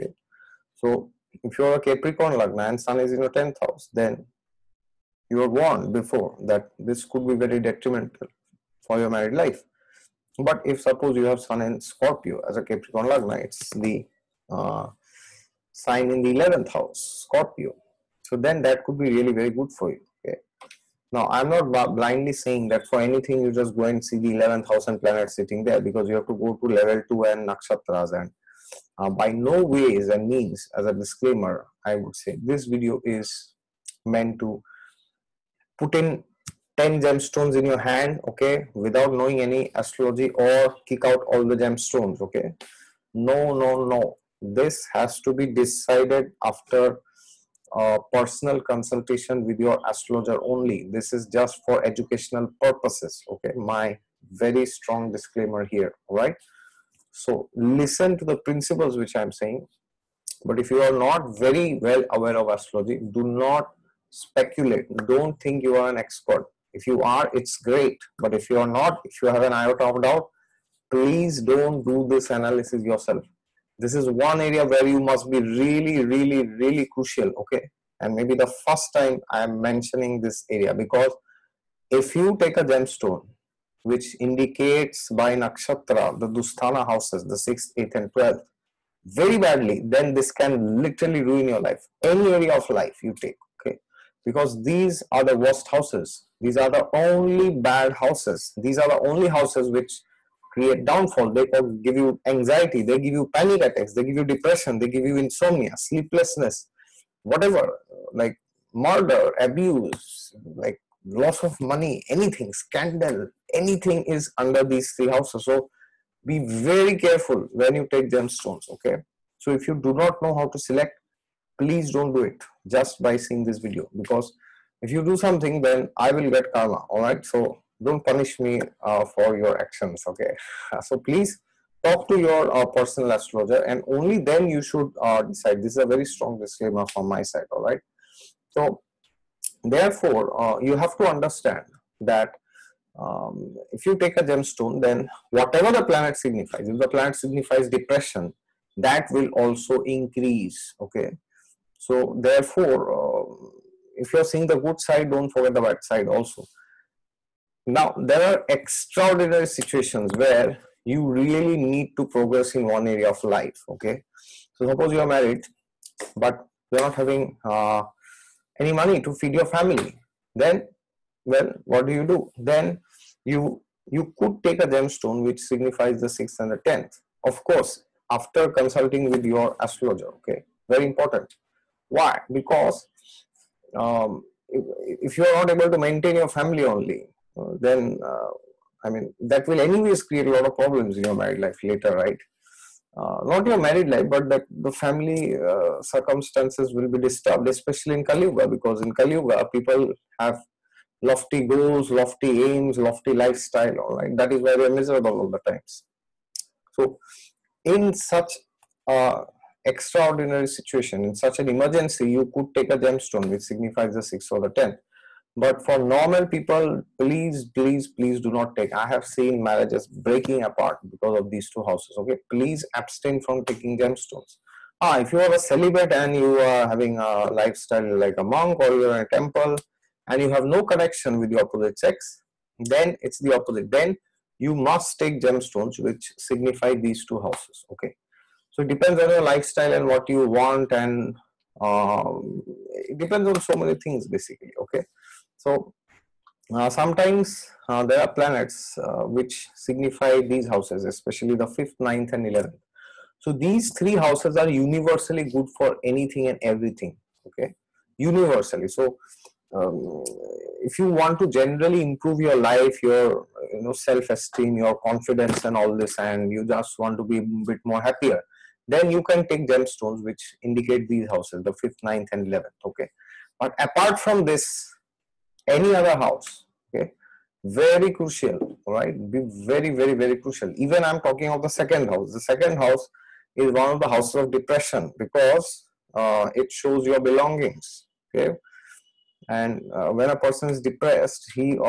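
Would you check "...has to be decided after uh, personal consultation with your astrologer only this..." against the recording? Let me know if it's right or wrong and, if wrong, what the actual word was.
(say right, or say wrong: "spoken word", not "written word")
right.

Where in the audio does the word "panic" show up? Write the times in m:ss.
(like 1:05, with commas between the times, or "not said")
1:43.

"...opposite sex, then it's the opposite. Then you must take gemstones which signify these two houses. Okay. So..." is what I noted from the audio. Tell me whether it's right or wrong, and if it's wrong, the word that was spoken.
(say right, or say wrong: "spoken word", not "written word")
right.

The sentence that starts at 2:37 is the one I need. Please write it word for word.
Now, there are extraordinary situations where you really need to progress in one area of life.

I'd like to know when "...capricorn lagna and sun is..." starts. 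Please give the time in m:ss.
0:01.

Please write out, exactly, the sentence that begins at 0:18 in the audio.
So then that could be really very good for you.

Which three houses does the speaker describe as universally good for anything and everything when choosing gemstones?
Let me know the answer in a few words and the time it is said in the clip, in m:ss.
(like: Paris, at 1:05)
5th, 9th and 11th, at 4:11.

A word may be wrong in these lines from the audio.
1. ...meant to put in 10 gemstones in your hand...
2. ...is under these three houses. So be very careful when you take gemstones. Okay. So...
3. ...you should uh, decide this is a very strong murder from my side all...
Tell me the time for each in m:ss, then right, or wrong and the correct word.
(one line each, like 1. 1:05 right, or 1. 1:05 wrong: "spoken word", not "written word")
1. 0:34 right
2. 1:54 right
3. 2:14 wrong: "disclaimer", not "murder".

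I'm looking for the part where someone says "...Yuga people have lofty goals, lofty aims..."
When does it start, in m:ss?
3:19.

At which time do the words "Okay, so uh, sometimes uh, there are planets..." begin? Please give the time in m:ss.
4:04.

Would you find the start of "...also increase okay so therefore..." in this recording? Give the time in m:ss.
2:29.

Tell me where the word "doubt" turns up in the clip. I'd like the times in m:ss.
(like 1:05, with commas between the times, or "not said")
1:10.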